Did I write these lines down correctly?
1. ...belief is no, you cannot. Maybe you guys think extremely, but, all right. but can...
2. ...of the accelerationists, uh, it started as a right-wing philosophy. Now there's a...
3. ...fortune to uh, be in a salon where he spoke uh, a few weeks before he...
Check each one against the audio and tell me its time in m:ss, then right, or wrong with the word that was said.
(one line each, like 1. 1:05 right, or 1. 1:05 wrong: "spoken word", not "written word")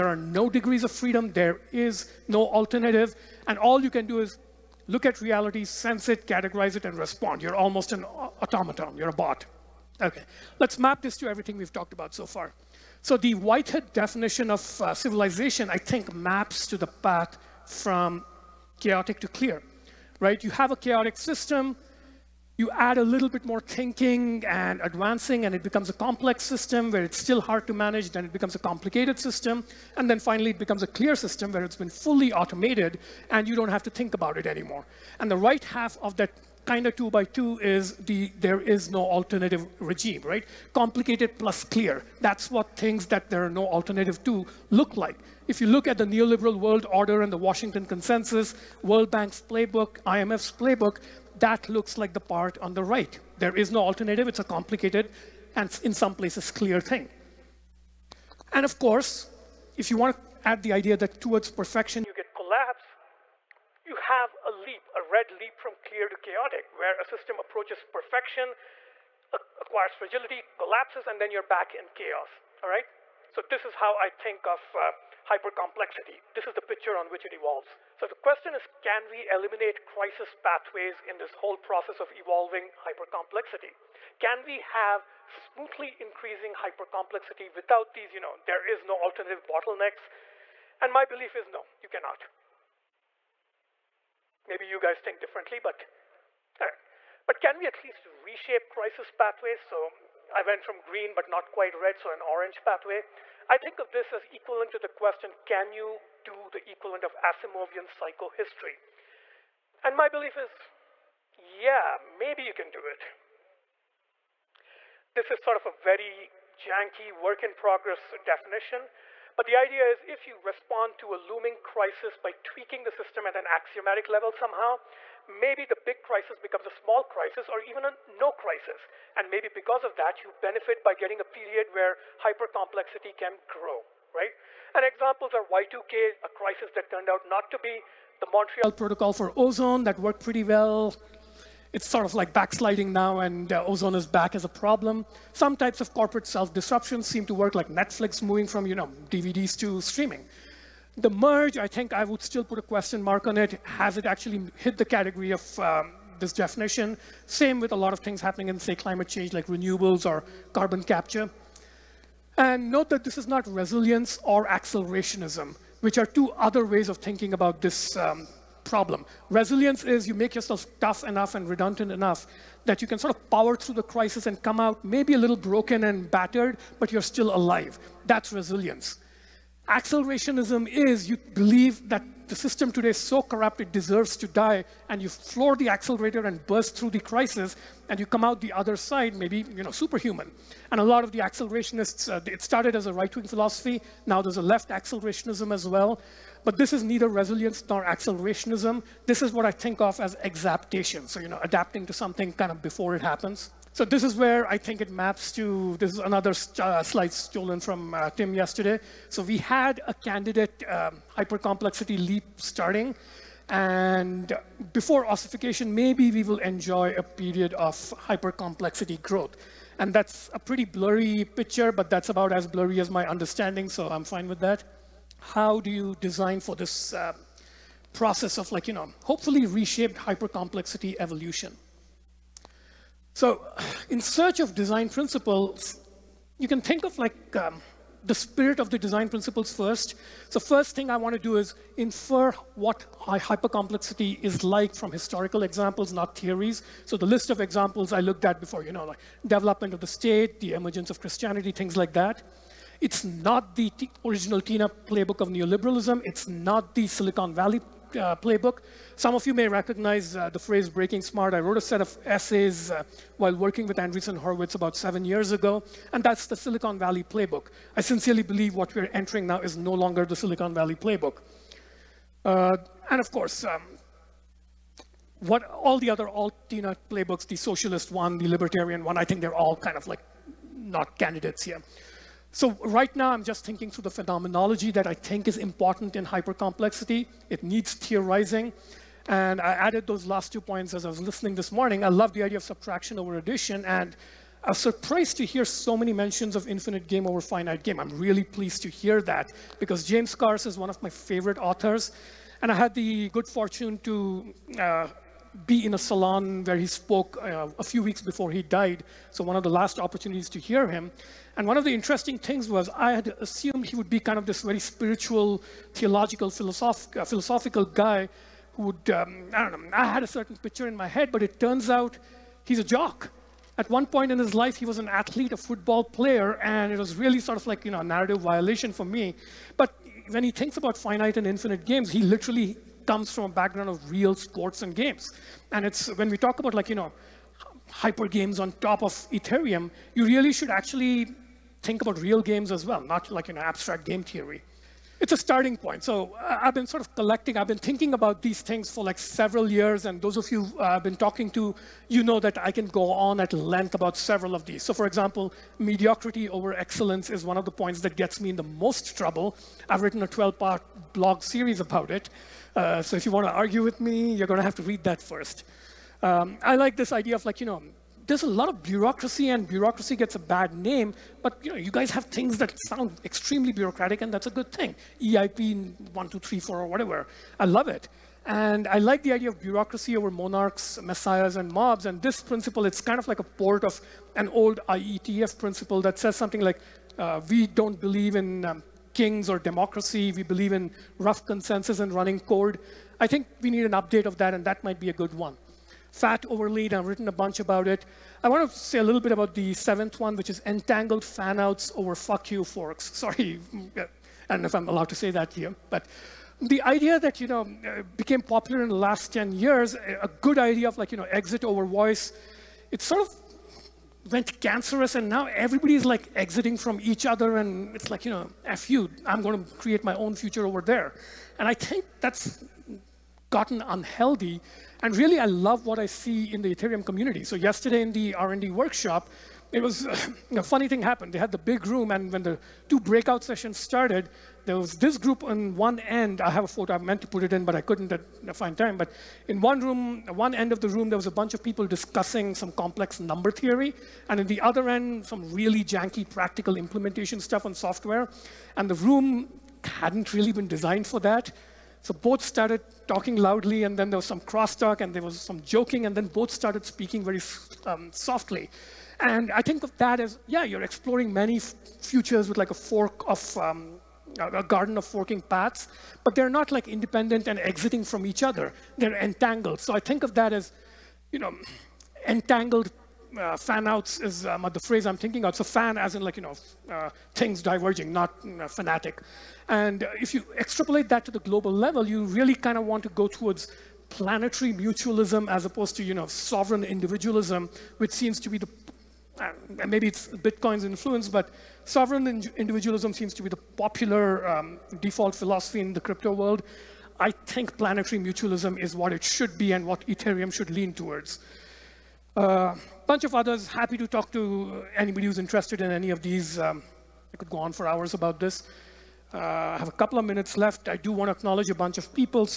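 1. 1:31 wrong: "differently", not "extremely"
2. 3:11 right
3. 5:03 right.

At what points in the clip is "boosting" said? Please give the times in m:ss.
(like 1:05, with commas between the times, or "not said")
not said.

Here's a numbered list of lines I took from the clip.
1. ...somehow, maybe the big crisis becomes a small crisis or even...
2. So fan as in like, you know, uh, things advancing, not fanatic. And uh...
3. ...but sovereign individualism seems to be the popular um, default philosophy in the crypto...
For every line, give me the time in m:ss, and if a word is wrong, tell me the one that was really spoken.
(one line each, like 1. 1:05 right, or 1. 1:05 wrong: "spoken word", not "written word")
1. 2:04 right
2. 7:55 wrong: "diverging", not "advancing"
3. 8:11 right.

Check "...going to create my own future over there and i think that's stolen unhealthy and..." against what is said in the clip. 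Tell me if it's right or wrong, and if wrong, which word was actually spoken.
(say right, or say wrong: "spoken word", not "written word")
wrong: "gotten", not "stolen".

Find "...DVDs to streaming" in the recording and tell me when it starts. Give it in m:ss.
2:29.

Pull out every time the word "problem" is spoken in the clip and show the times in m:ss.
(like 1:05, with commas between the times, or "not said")
2:24, 2:48.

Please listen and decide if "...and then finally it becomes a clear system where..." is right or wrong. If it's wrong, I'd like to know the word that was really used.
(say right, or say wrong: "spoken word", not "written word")
right.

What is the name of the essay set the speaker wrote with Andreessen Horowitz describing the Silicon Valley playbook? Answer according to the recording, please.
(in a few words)
Breaking Smart.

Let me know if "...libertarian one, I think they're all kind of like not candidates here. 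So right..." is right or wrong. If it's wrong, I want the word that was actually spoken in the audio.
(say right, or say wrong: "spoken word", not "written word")
right.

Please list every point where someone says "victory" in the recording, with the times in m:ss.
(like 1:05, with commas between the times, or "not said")
not said.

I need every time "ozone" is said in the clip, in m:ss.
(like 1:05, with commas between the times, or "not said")
2:19, 2:23.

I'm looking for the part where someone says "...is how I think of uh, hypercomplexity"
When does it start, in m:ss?
1:13.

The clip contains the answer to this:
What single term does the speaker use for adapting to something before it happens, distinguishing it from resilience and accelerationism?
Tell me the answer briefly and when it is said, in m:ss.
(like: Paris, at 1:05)
exaptation, at 3:20.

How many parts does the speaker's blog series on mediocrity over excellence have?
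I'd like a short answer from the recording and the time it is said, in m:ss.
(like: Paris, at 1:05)
12, at 6:00.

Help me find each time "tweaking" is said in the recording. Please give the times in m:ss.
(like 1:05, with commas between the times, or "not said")
2:02.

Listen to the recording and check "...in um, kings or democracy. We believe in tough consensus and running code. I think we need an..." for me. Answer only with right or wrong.
wrong.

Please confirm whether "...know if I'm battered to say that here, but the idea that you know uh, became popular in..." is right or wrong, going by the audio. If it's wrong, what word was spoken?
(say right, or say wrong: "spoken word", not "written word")
wrong: "allowed", not "battered".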